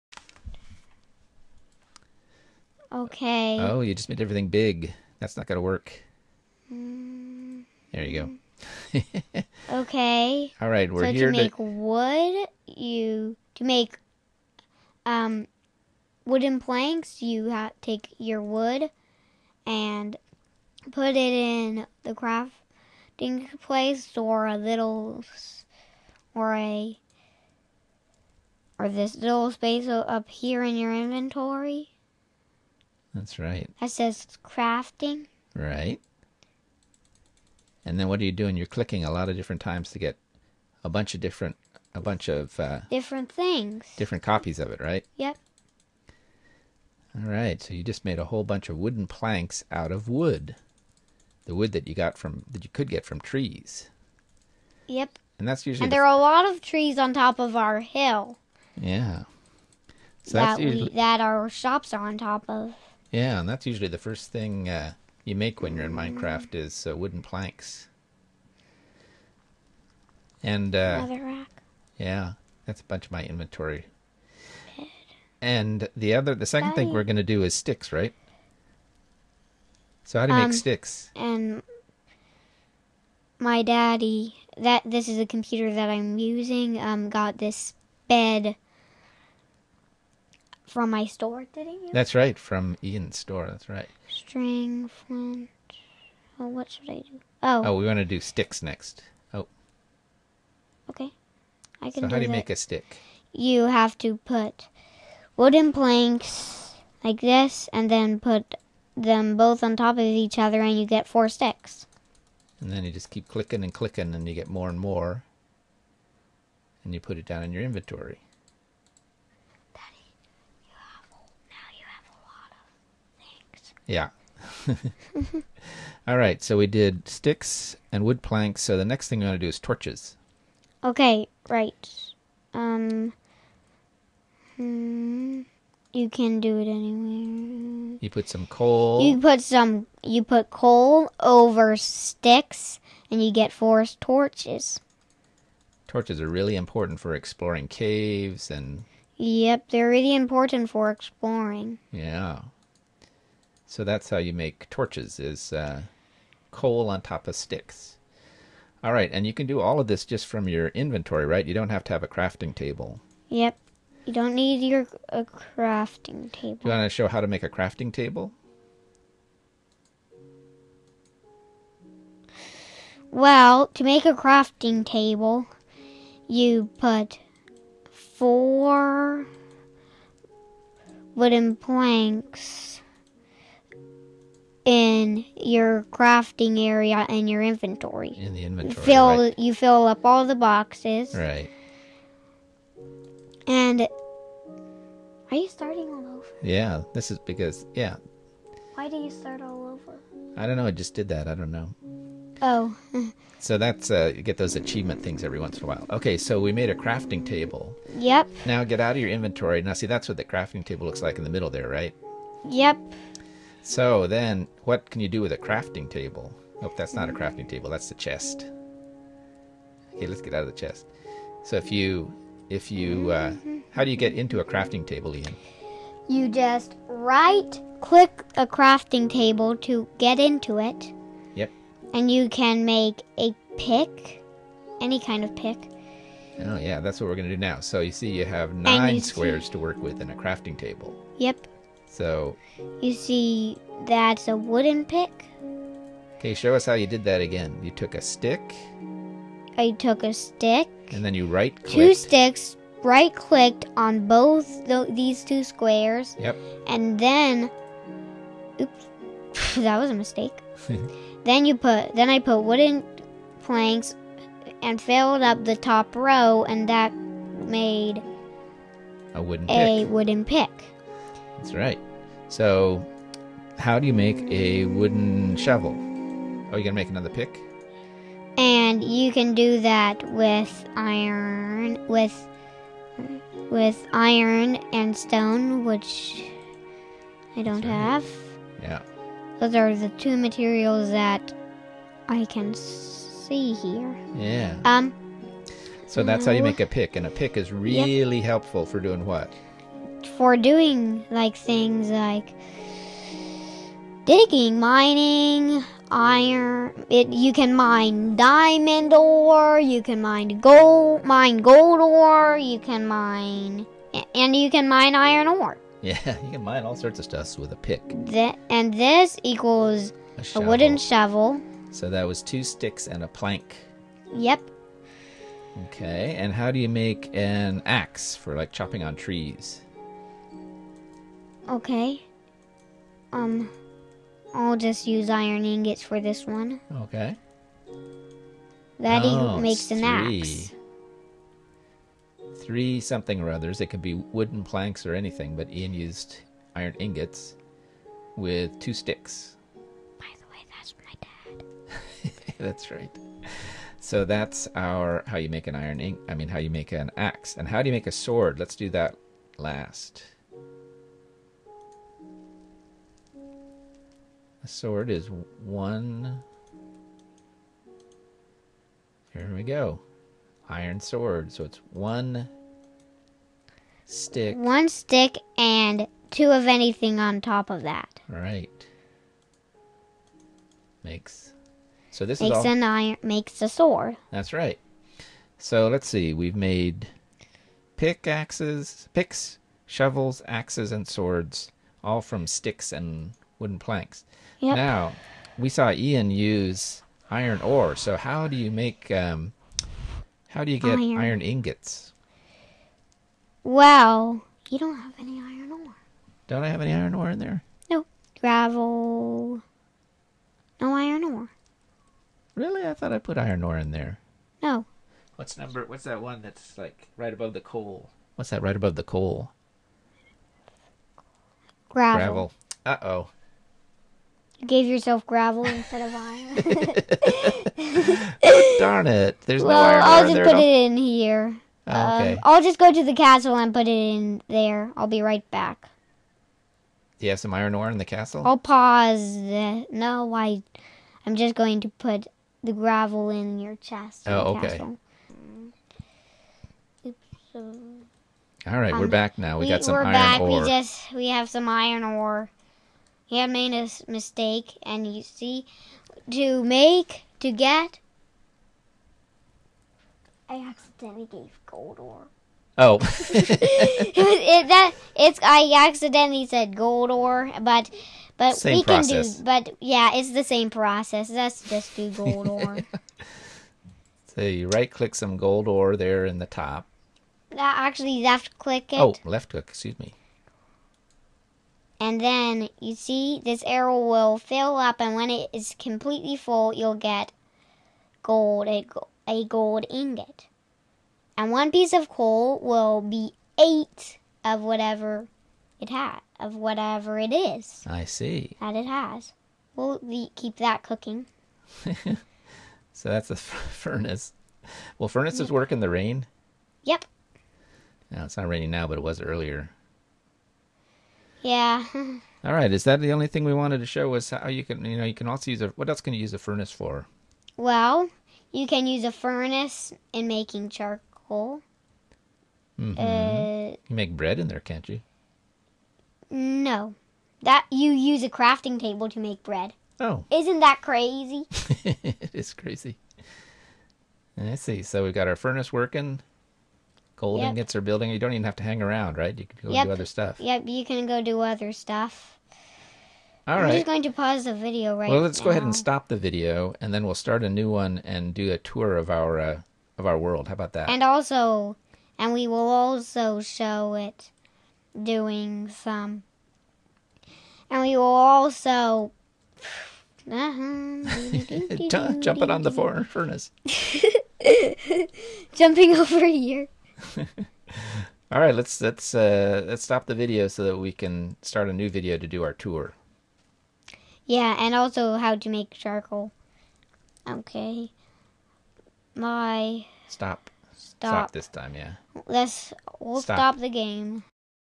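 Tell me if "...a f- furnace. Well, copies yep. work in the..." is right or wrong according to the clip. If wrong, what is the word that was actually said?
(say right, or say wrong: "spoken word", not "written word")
wrong: "furnaces", not "copies".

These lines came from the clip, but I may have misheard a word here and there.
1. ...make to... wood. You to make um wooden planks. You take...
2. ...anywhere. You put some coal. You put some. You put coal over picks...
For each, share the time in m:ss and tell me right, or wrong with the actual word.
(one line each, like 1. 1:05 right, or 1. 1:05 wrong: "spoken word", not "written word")
1. 0:11 right
2. 2:16 wrong: "sticks", not "picks".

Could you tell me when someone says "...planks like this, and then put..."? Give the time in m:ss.
1:45.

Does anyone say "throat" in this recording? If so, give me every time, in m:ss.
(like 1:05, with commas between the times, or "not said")
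not said.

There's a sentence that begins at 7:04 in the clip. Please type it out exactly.
You gave yourself gravel instead of iron.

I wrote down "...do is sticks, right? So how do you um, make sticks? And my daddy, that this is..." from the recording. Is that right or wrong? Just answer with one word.
right.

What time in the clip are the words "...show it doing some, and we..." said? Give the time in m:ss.
9:13.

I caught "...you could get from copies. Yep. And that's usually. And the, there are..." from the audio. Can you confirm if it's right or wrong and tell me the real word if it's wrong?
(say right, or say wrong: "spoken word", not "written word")
wrong: "trees", not "copies".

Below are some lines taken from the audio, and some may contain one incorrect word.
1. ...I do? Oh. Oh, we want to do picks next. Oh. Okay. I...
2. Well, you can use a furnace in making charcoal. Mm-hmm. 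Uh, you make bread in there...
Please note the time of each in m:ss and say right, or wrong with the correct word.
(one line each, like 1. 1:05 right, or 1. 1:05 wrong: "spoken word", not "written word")
1. 1:36 wrong: "sticks", not "picks"
2. 8:37 right.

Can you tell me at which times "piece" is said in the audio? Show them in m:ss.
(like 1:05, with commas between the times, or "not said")
8:11.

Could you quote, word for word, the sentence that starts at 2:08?
So the next thing we want to do is torches.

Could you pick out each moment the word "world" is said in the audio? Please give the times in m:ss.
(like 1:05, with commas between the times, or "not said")
9:09.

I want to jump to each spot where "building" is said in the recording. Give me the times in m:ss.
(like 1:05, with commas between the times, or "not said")
8:57.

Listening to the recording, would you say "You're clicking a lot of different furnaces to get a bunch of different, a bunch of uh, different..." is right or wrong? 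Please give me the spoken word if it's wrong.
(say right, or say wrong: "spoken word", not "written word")
wrong: "times", not "furnaces".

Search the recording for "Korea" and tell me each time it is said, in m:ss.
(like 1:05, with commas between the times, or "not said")
not said.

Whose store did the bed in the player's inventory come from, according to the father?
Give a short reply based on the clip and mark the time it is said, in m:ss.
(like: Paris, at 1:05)
Ian's store, at 1:32.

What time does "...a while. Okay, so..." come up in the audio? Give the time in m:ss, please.
3:25.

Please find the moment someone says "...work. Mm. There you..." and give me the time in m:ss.
0:05.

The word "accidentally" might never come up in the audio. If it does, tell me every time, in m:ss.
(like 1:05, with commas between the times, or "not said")
7:40, 7:45.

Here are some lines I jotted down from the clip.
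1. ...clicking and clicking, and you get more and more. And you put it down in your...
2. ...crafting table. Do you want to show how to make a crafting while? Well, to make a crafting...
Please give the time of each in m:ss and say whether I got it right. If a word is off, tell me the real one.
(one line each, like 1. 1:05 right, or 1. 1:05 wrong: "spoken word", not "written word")
1. 1:53 right
2. 2:45 wrong: "table", not "while".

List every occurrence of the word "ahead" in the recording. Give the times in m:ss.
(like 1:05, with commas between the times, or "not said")
9:05.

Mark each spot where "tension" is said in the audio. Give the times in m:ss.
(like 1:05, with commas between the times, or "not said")
not said.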